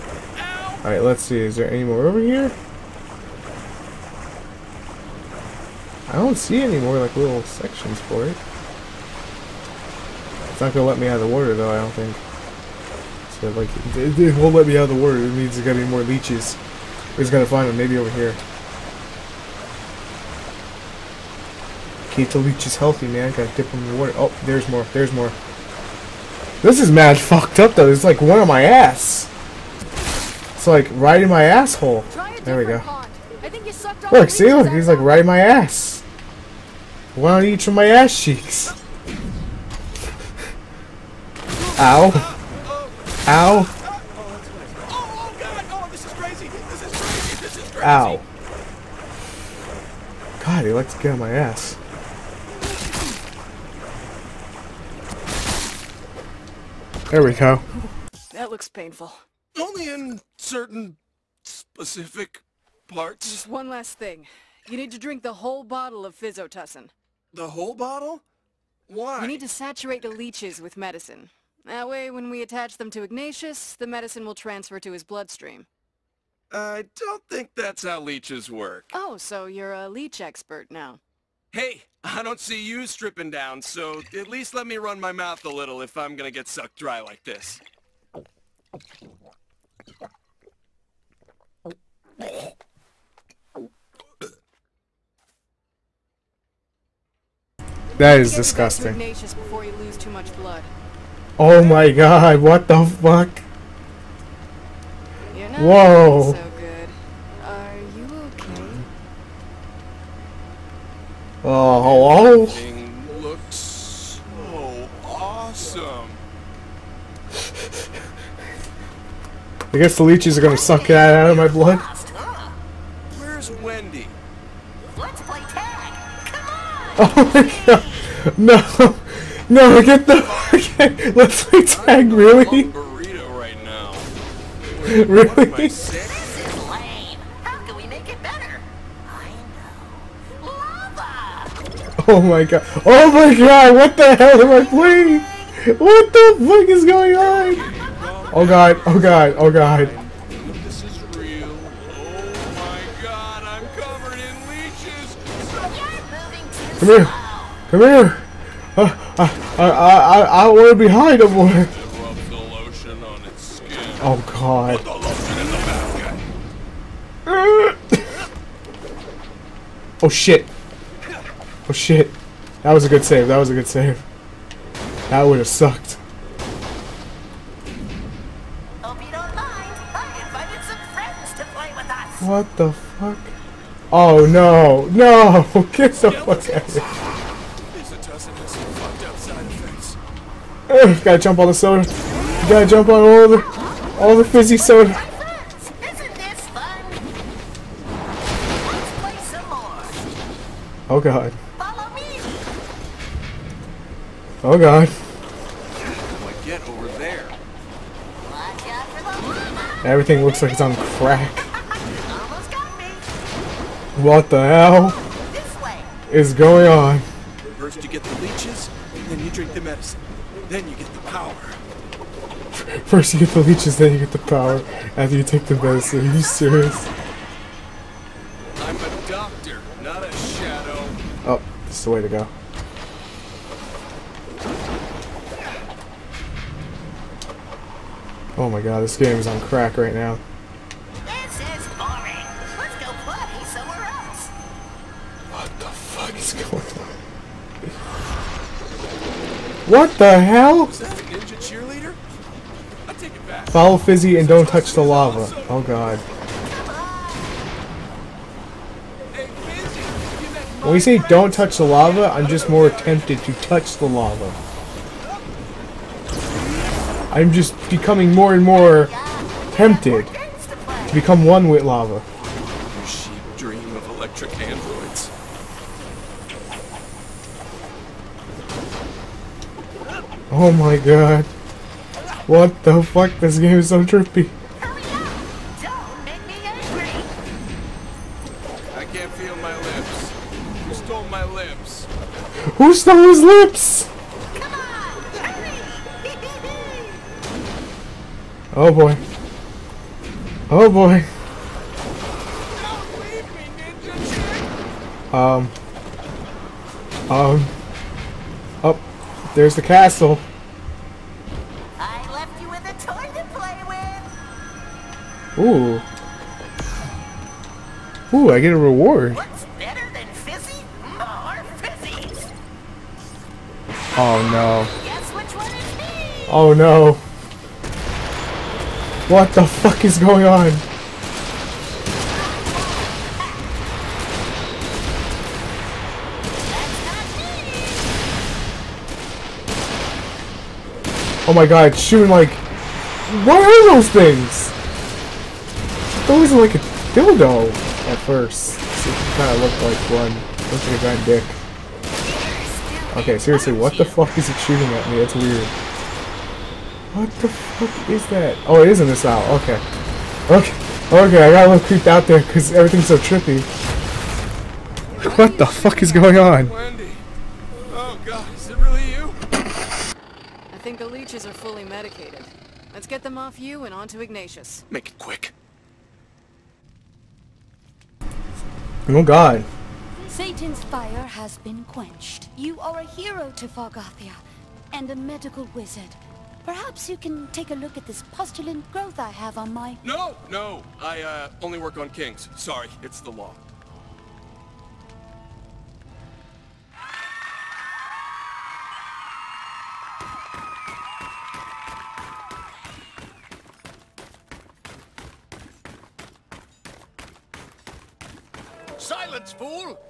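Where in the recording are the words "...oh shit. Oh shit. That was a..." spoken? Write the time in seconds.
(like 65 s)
170 s.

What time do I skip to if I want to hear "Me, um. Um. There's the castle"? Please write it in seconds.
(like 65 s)
306 s.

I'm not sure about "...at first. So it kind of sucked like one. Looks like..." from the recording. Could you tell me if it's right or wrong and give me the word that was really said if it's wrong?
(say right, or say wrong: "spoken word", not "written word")
wrong: "looked", not "sucked".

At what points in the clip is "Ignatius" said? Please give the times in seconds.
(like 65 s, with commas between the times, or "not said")
73 s, 374 s.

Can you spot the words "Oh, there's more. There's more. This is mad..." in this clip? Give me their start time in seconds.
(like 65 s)
24 s.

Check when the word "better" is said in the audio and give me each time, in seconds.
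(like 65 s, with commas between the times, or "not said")
138 s, 319 s.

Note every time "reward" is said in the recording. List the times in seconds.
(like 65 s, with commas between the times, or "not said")
318 s.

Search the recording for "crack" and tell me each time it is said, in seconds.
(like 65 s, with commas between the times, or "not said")
210 s, 239 s.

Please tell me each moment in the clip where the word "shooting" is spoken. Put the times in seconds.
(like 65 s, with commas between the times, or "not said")
341 s, 354 s.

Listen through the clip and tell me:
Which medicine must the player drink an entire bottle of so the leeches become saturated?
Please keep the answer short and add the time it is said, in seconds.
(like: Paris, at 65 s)
Physotussin, at 66 s.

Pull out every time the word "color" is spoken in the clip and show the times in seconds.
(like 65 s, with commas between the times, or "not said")
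not said.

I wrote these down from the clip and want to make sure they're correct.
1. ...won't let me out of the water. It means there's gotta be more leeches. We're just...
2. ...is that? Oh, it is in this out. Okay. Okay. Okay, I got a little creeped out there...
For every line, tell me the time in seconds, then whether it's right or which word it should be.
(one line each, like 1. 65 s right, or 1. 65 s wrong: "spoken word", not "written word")
1. 14 s right
2. 357 s right.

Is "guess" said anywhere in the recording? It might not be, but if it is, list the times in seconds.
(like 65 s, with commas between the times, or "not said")
119 s, 324 s.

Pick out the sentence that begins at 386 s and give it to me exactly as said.
Perhaps you can take a look at this pustulant growth I have on my...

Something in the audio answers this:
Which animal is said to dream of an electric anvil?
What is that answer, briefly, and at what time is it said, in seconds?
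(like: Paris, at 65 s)
sheep, at 272 s.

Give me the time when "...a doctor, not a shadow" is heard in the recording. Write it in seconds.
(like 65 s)
228 s.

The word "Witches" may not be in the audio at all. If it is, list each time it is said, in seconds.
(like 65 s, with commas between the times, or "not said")
371 s.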